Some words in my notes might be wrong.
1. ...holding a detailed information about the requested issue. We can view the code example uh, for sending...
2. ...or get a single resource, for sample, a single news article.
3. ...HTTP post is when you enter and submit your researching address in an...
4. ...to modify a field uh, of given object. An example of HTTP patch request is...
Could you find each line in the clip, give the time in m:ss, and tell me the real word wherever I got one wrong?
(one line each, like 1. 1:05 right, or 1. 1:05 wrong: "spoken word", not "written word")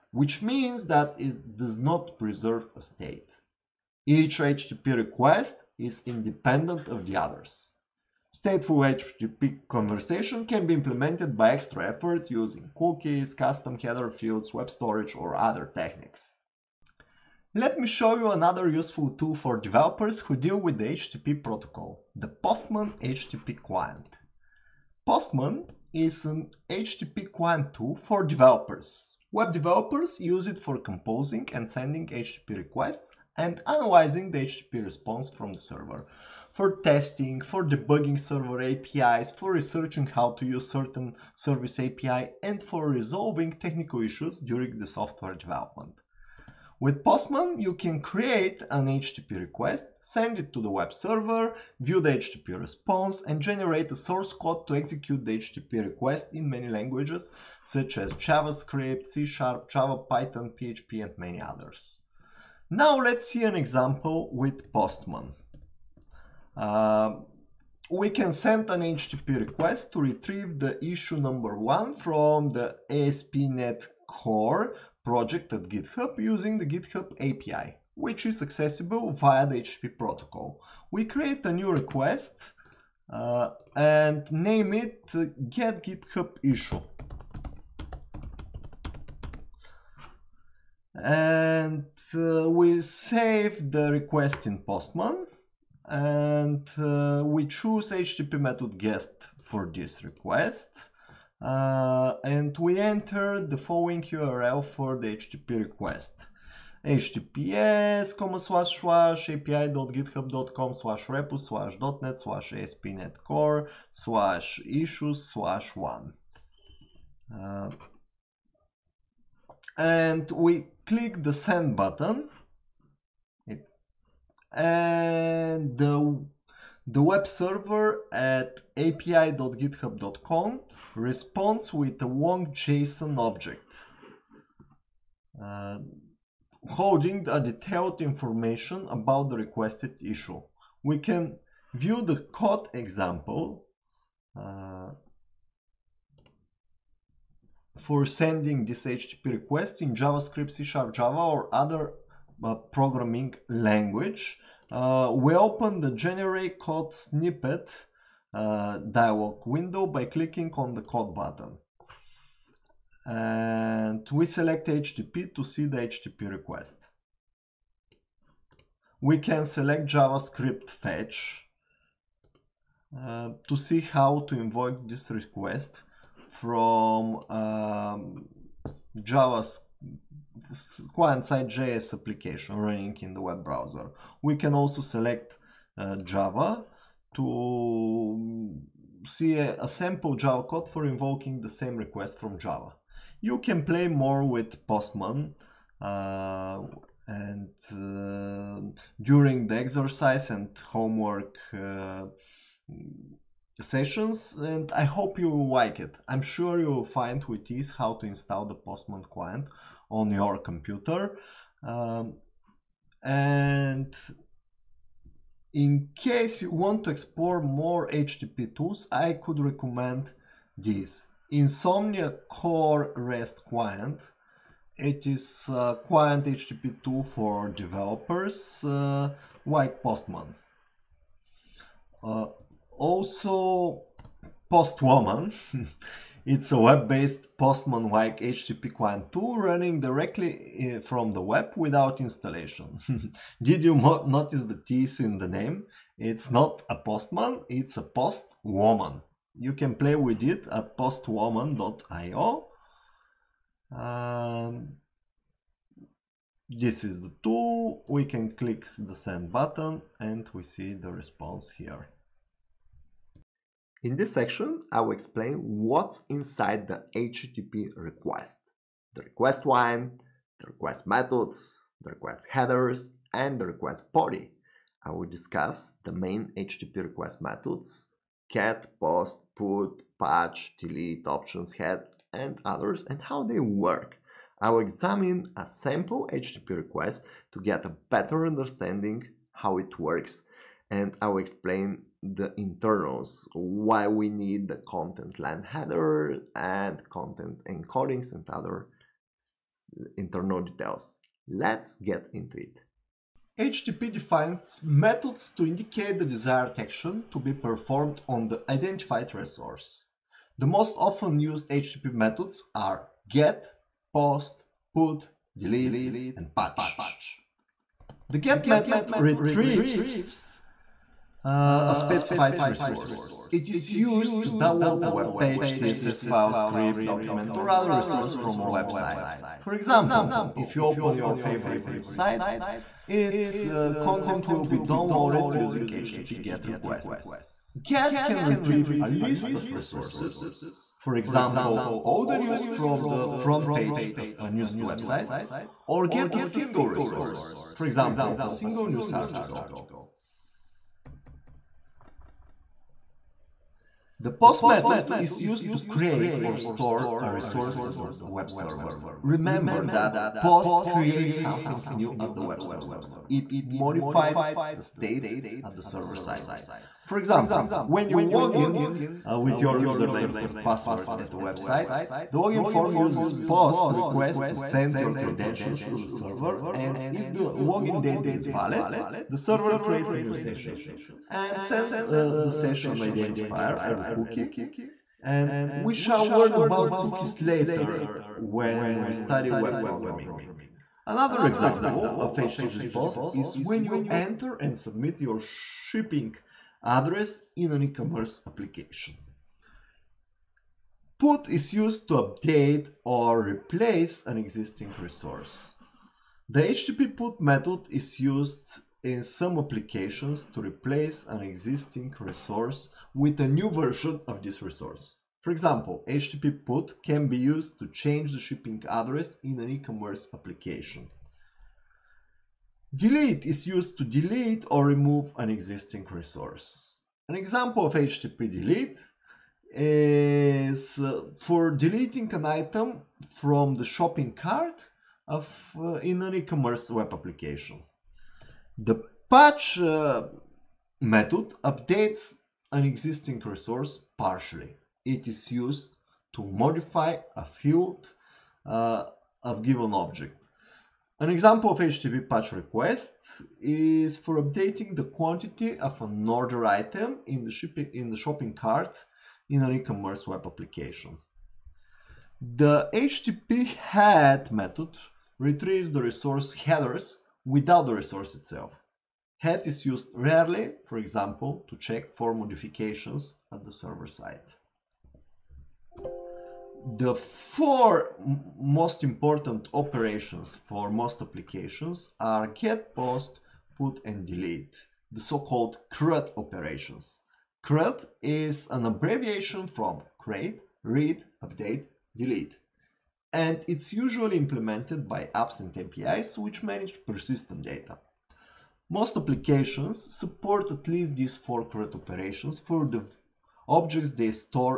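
1. 2:16 right
2. 5:45 wrong: "example", not "sample"
3. 6:32 wrong: "shipping", not "researching"
4. 7:26 right.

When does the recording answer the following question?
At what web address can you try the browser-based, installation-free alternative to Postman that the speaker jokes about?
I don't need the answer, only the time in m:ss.
4:10.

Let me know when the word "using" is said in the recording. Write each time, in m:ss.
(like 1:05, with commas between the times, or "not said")
0:12, 1:16, 5:35.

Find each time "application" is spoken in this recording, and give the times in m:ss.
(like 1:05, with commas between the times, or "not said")
3:01, 6:38, 6:49, 7:00, 7:16, 7:40, 8:01, 8:18.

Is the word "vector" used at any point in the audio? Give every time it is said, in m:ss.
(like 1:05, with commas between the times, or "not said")
not said.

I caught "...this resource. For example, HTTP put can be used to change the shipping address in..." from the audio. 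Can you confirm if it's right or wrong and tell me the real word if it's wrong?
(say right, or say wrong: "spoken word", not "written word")
right.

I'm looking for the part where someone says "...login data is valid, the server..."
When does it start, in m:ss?
6:17.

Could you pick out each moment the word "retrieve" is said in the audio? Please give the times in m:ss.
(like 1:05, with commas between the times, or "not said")
1:10, 5:18, 5:38, 7:45.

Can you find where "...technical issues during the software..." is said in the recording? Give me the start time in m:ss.
0:43.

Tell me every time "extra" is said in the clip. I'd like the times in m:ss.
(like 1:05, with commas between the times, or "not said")
0:11.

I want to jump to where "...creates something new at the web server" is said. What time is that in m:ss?
6:00.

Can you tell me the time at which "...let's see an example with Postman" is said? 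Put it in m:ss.
1:02.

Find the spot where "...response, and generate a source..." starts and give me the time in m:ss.
0:52.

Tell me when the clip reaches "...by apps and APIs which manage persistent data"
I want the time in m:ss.
8:14.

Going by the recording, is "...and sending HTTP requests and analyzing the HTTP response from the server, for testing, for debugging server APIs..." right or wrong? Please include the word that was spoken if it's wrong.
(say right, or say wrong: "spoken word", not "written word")
right.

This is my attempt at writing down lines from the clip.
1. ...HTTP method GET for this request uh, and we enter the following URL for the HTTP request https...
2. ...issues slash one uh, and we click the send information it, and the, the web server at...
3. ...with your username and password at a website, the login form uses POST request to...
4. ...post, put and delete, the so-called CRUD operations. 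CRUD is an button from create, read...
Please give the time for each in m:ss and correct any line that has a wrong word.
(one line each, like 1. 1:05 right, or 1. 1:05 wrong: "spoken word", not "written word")
1. 1:38 right
2. 1:54 wrong: "button", not "information"
3. 6:09 right
4. 8:02 wrong: "abbreviation", not "button".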